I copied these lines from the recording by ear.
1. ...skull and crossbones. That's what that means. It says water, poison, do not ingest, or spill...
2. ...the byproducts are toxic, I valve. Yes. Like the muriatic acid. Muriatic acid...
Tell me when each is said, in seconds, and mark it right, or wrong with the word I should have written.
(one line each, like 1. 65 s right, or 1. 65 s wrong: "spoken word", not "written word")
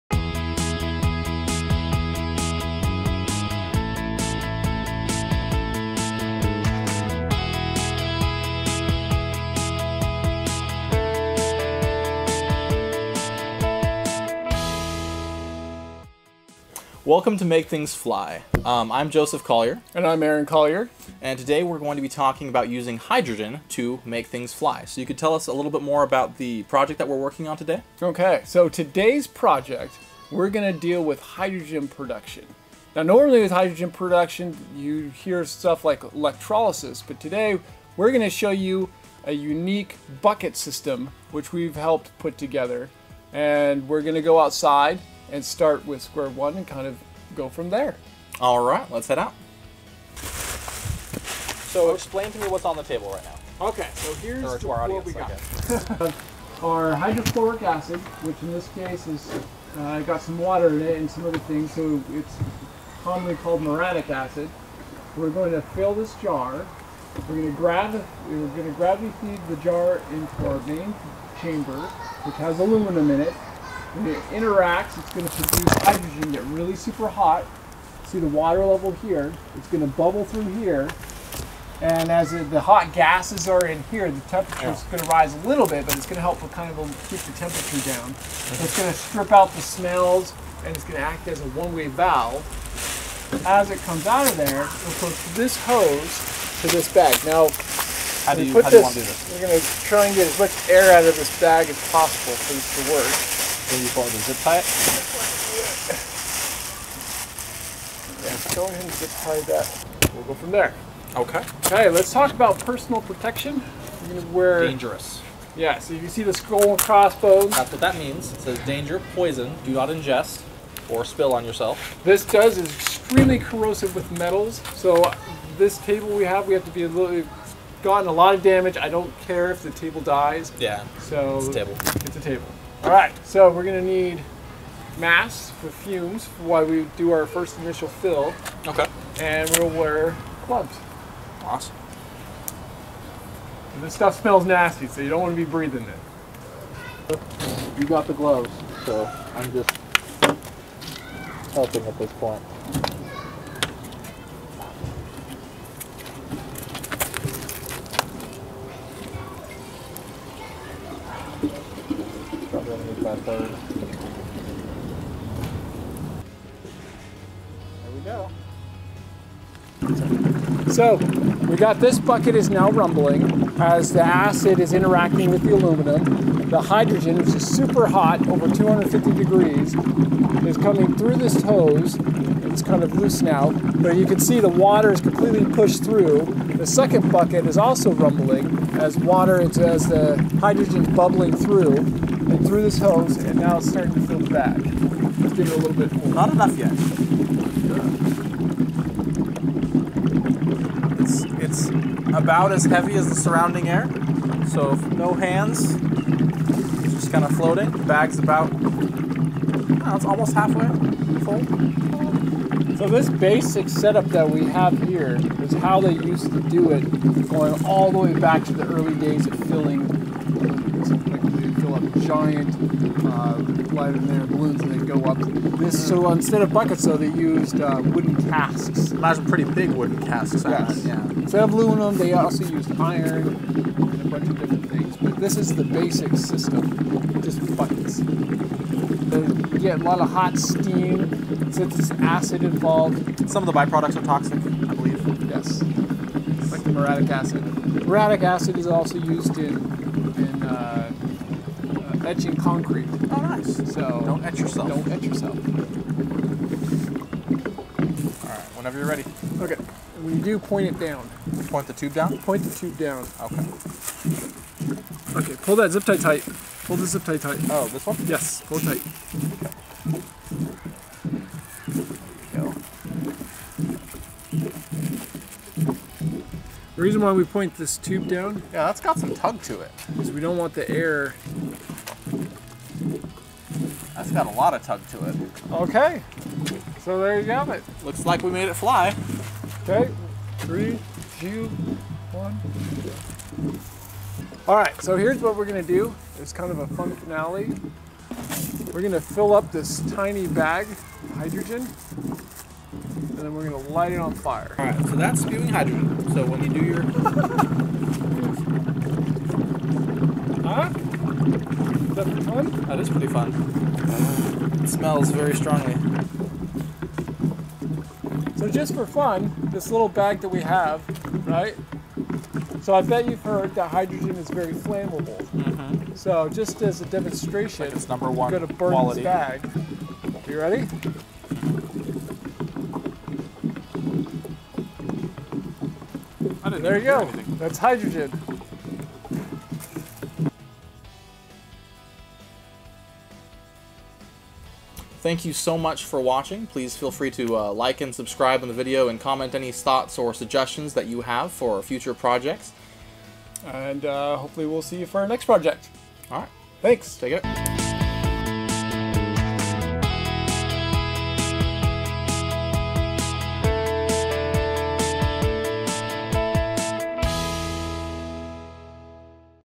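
1. 116 s wrong: "danger", not "water"
2. 243 s wrong: "believe", not "valve".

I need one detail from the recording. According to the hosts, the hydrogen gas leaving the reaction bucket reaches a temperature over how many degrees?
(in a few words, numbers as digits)
250 degrees.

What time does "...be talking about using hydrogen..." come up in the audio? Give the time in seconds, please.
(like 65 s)
22 s.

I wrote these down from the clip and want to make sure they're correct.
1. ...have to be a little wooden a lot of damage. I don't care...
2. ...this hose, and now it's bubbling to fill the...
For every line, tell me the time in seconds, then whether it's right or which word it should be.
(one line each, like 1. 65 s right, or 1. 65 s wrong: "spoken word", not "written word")
1. 126 s wrong: "gotten", not "wooden"
2. 192 s wrong: "starting", not "bubbling".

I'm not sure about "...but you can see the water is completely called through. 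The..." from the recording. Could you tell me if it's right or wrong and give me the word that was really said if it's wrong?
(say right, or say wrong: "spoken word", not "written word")
wrong: "pushed", not "called".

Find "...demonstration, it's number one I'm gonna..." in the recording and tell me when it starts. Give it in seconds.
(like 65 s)
326 s.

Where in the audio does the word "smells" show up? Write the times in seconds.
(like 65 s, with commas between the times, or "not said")
89 s, 144 s, 314 s.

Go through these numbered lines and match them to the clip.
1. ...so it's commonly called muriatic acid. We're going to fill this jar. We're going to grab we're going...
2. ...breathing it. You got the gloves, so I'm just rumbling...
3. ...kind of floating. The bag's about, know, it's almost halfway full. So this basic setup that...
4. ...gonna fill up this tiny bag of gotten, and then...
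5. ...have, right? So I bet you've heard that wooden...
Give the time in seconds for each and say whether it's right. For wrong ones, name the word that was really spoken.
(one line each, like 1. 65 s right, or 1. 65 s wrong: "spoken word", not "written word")
1. 61 s right
2. 145 s wrong: "helping", not "rumbling"
3. 207 s right
4. 298 s wrong: "hydrogen", not "gotten"
5. 320 s wrong: "hydrogen", not "wooden".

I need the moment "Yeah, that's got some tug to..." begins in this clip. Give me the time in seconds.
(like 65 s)
278 s.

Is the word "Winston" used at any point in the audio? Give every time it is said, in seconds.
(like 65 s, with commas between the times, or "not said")
not said.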